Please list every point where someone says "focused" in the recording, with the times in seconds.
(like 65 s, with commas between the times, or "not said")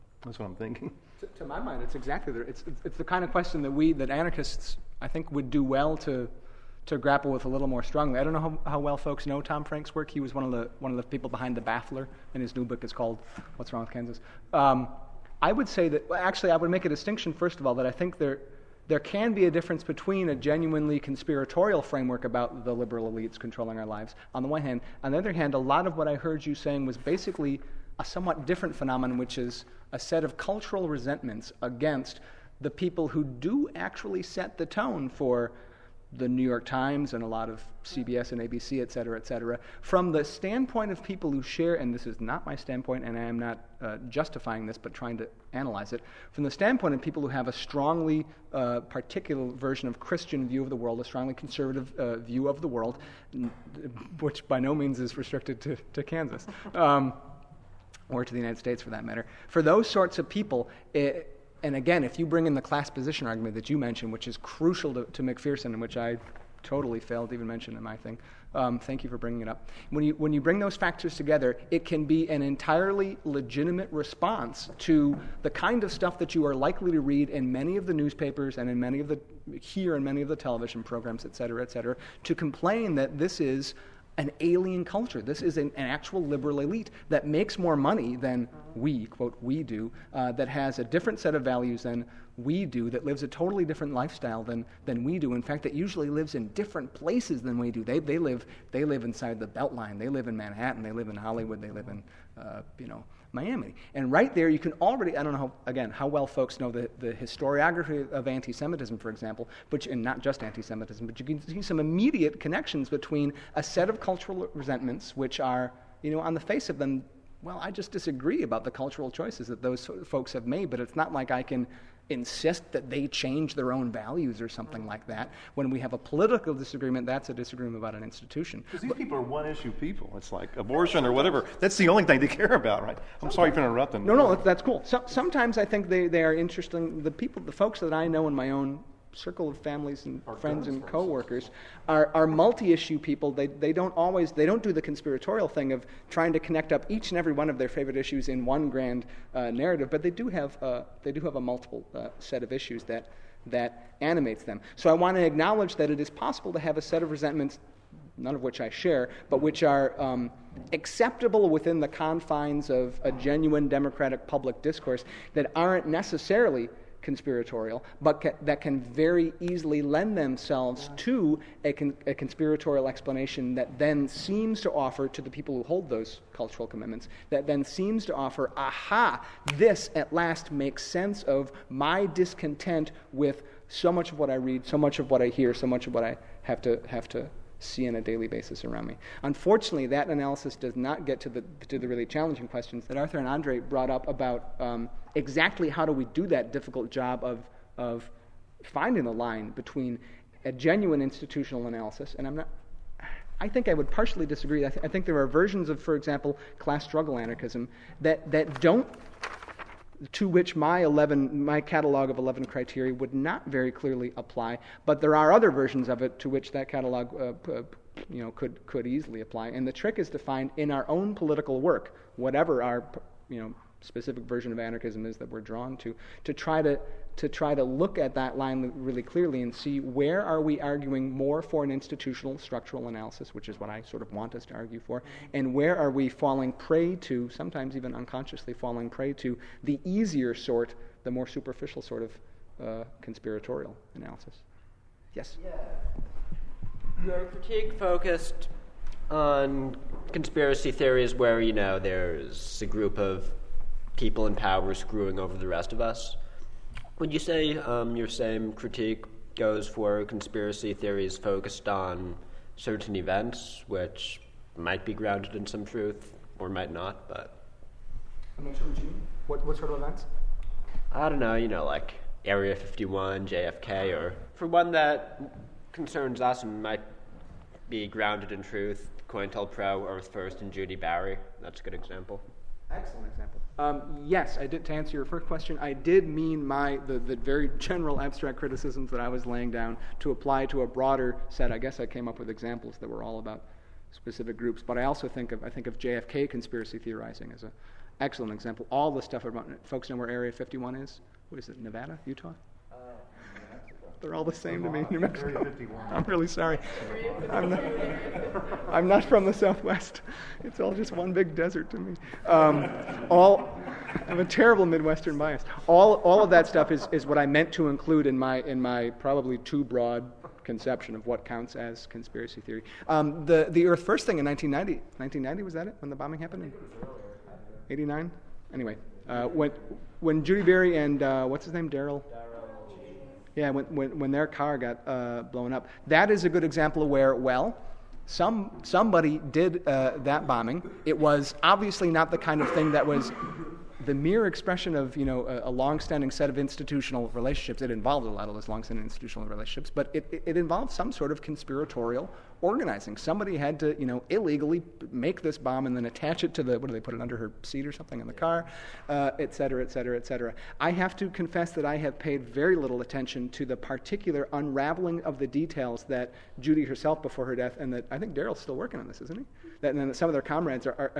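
247 s, 261 s.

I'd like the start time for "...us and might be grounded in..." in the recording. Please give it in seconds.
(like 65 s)
276 s.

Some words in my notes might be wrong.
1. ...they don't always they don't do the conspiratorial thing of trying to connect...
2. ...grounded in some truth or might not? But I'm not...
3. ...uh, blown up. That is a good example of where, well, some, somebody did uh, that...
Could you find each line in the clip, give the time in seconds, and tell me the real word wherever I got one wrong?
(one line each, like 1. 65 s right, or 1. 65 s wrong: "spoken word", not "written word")
1. 143 s right
2. 264 s right
3. 334 s right.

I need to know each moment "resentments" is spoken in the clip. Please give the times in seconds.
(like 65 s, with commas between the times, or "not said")
30 s, 114 s, 157 s.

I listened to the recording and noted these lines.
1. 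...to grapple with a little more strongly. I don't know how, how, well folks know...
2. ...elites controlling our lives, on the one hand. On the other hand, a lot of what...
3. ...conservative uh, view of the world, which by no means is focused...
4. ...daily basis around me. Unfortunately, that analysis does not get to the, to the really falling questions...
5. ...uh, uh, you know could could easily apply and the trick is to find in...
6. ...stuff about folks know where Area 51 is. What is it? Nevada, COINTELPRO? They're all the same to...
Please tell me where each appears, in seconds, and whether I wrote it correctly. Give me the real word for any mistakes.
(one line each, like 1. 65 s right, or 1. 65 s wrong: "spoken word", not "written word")
1. 6 s right
2. 23 s right
3. 51 s wrong: "restricted", not "focused"
4. 188 s wrong: "challenging", not "falling"
5. 217 s right
6. 299 s wrong: "Utah", not "COINTELPRO".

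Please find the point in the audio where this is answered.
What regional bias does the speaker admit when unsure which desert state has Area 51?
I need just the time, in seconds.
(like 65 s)
314 s.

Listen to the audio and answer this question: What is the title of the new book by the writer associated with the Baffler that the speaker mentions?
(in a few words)
What's Wrong with Kansas.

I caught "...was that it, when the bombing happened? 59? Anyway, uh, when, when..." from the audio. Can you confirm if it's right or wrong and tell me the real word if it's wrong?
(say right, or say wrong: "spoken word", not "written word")
wrong: "89", not "59".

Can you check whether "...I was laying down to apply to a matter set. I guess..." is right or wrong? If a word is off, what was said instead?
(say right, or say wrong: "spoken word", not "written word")
wrong: "broader", not "matter".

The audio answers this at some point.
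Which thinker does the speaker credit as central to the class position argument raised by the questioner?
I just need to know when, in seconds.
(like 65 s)
65 s.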